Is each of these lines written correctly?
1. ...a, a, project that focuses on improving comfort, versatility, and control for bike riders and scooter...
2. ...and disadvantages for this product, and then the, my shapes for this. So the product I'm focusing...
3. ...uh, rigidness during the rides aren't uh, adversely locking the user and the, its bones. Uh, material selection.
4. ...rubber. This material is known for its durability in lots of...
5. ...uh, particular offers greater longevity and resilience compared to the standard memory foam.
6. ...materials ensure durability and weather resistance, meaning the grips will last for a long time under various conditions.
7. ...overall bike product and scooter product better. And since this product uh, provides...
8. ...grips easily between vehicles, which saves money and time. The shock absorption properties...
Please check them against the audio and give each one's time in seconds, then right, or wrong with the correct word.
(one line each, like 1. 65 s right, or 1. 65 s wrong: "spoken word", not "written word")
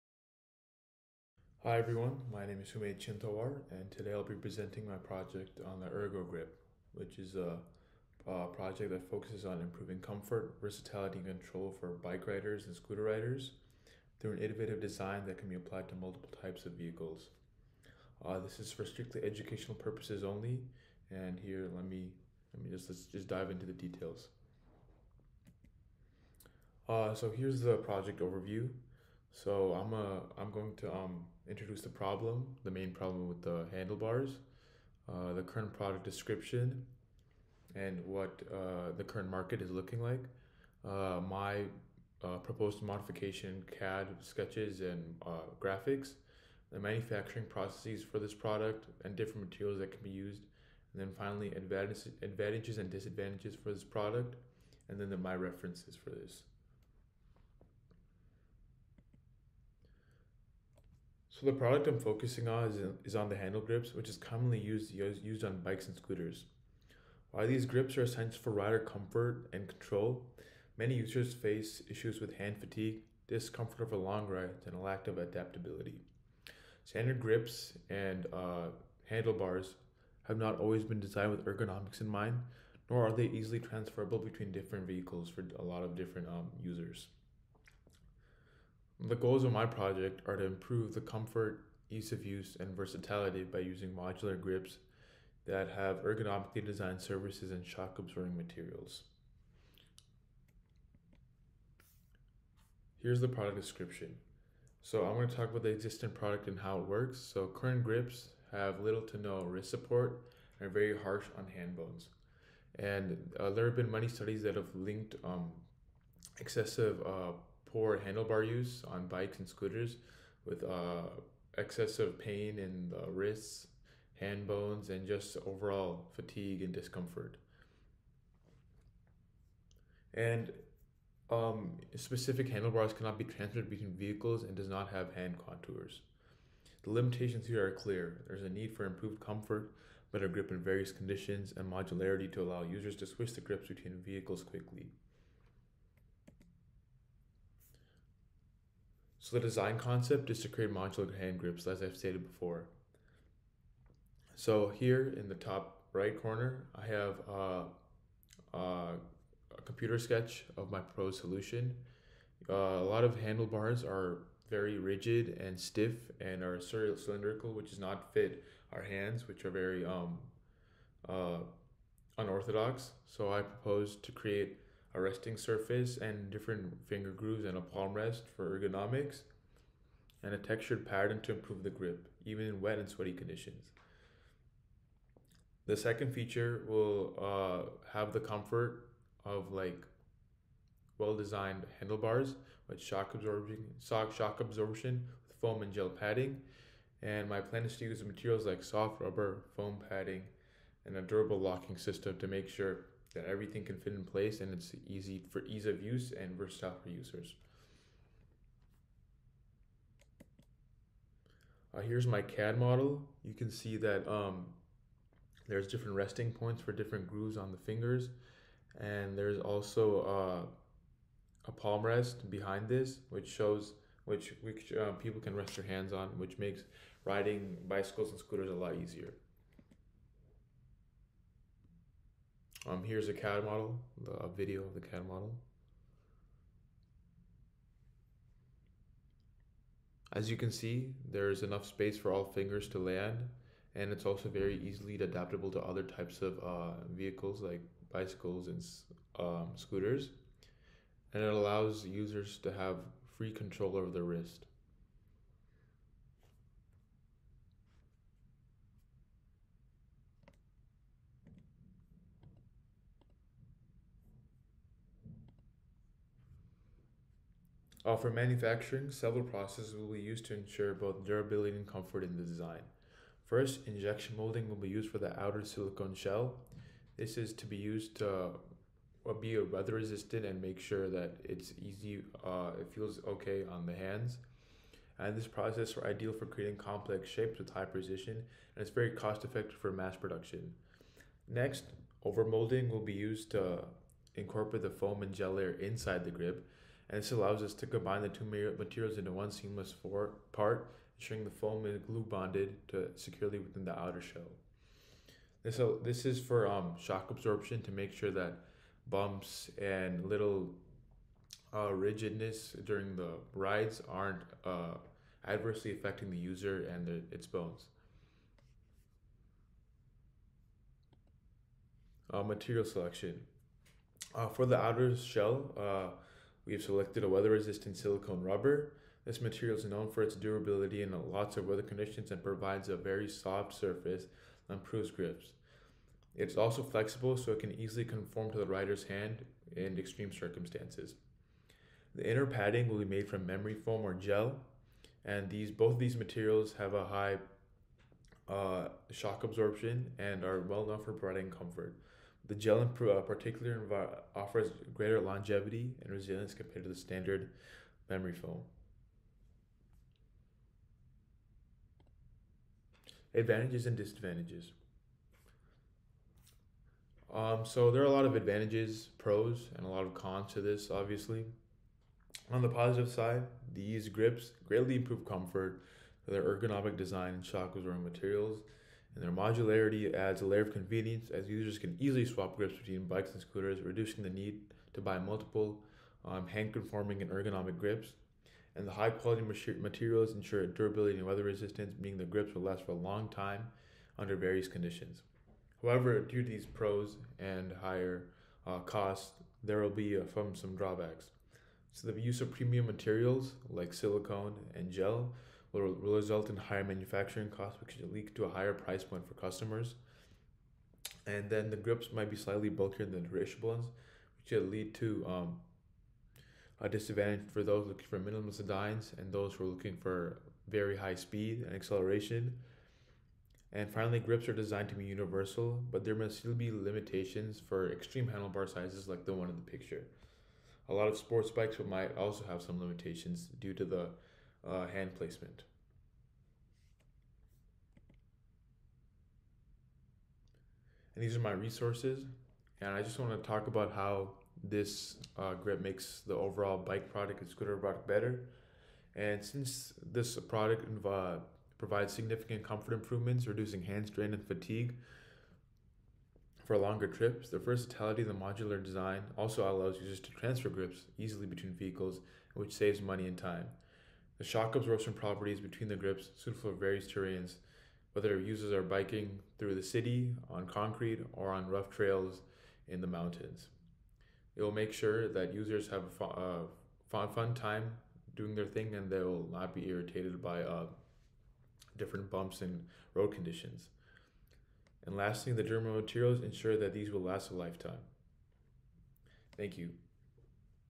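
1. 7 s right
2. 52 s wrong: "references", not "shapes"
3. 311 s wrong: "affecting", not "locking"
4. 328 s right
5. 352 s right
6. 389 s right
7. 446 s right
8. 460 s right.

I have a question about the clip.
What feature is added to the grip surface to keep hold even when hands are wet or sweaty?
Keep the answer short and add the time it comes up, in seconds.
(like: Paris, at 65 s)
Textured pattern, at 180 s.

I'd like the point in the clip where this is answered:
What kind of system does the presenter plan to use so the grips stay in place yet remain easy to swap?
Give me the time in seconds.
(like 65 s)
201 s.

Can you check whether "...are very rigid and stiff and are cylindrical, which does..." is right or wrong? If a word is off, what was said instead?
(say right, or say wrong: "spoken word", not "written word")
right.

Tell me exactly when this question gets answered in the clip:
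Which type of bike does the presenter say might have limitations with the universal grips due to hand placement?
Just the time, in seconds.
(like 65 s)
430 s.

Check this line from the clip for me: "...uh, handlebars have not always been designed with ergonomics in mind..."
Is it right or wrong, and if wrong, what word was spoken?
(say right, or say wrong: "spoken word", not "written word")
right.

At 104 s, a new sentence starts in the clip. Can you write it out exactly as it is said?
So I'm going to talk about the existing product and how it works.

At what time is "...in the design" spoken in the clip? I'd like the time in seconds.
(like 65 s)
272 s.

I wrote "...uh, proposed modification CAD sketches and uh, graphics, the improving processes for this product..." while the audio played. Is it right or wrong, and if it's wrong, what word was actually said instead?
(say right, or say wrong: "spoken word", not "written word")
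wrong: "manufacturing", not "improving".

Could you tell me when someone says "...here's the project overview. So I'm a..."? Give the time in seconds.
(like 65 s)
27 s.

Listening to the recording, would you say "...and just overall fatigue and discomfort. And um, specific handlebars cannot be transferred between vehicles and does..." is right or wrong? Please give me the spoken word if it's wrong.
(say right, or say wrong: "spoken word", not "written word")
right.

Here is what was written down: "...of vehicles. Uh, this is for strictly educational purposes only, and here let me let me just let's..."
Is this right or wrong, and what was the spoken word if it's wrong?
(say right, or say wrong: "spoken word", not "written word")
right.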